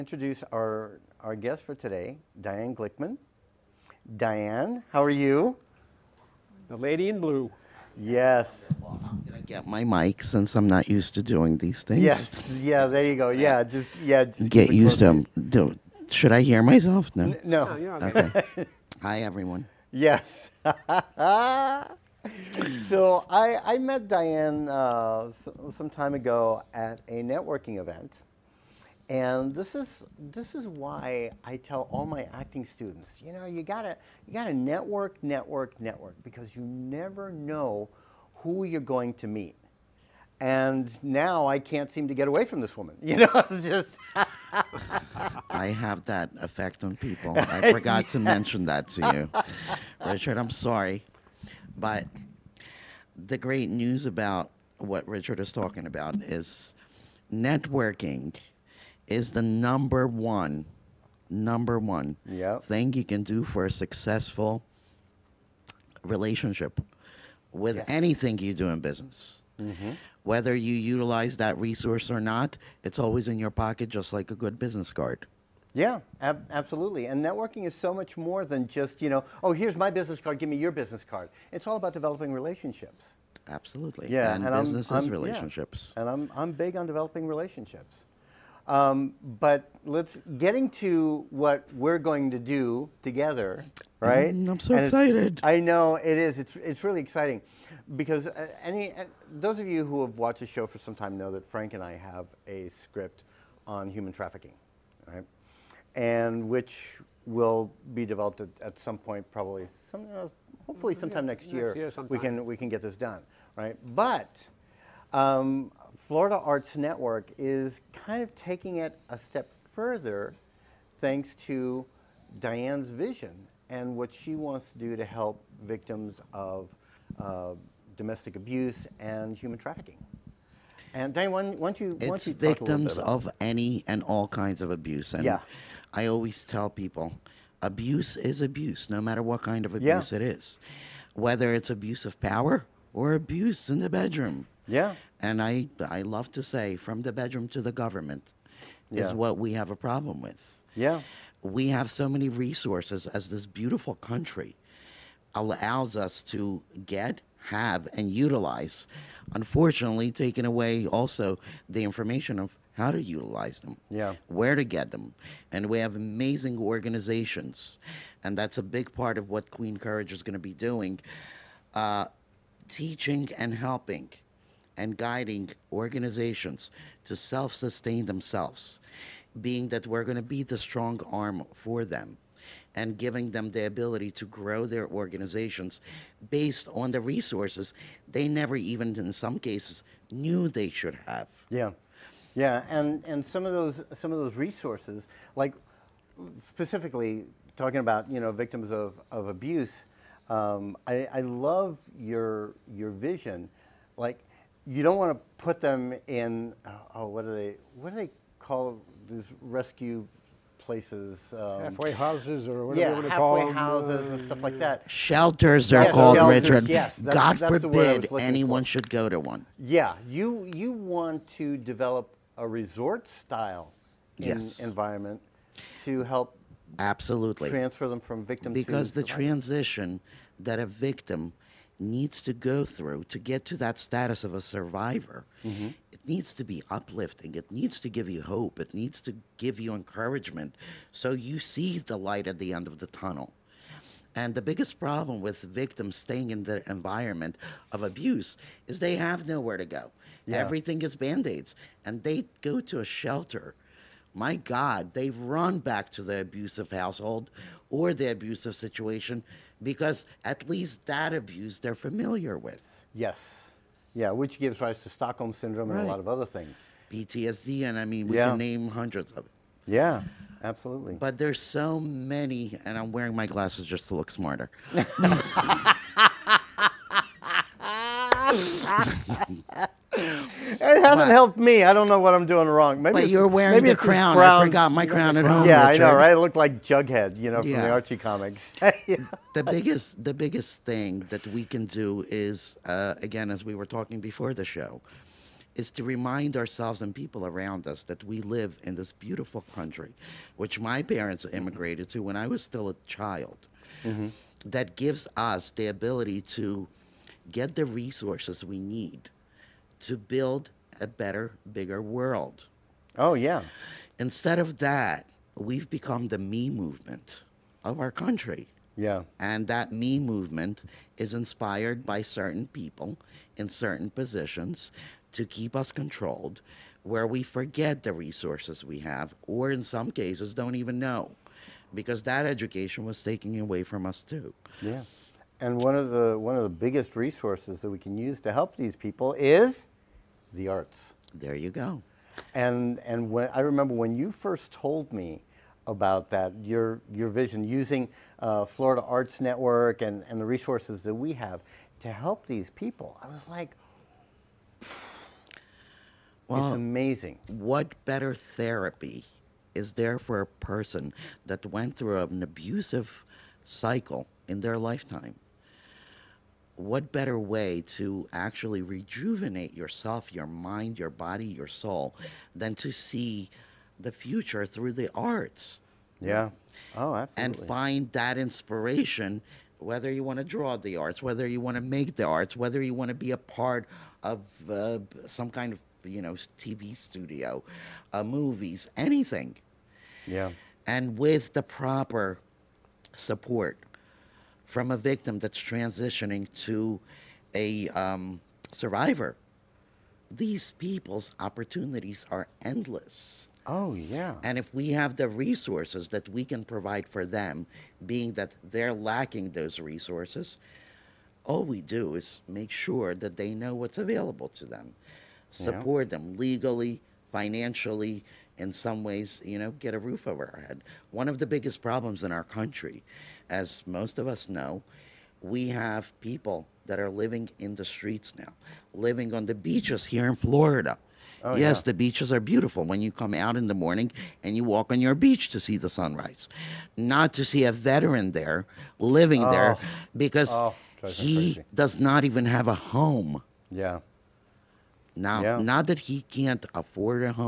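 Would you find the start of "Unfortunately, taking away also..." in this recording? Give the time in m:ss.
2:39.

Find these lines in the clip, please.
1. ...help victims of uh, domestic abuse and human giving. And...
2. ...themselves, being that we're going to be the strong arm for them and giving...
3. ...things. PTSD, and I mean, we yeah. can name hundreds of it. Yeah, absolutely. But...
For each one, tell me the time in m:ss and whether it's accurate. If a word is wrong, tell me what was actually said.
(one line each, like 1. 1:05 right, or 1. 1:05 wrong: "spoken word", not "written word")
1. 2:05 wrong: "trafficking", not "giving"
2. 2:58 right
3. 4:26 right.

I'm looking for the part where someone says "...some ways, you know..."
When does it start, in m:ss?
6:58.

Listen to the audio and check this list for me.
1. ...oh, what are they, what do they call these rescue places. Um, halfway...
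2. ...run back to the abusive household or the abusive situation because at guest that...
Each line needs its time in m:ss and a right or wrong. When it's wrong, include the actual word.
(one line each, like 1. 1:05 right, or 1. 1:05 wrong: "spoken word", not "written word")
1. 3:26 right
2. 4:15 wrong: "least", not "guest".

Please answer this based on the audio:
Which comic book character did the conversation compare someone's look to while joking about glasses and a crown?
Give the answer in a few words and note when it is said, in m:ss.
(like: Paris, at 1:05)
Jughead, at 4:46.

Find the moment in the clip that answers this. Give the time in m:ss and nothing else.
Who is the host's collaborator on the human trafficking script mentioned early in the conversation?
1:41.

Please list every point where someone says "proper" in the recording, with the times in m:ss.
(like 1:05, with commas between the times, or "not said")
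6:31.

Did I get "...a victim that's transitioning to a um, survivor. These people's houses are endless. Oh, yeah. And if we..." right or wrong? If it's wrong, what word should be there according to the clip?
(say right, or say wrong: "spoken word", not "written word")
wrong: "opportunities", not "houses".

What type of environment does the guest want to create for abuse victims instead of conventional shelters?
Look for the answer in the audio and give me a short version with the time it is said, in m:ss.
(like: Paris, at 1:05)
Resort style, at 3:42.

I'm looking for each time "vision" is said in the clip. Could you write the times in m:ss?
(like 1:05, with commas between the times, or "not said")
2:02, 3:22, 5:47.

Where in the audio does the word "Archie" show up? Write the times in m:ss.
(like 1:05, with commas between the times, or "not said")
4:47.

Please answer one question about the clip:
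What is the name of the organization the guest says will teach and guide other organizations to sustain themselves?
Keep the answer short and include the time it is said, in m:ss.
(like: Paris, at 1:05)
Queen Courage, at 2:49.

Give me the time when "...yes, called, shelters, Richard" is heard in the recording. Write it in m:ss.
3:35.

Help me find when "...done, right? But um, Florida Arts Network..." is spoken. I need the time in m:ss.
1:52.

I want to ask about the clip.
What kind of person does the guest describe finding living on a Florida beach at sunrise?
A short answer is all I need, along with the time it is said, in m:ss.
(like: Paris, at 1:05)
A veteran, at 7:17.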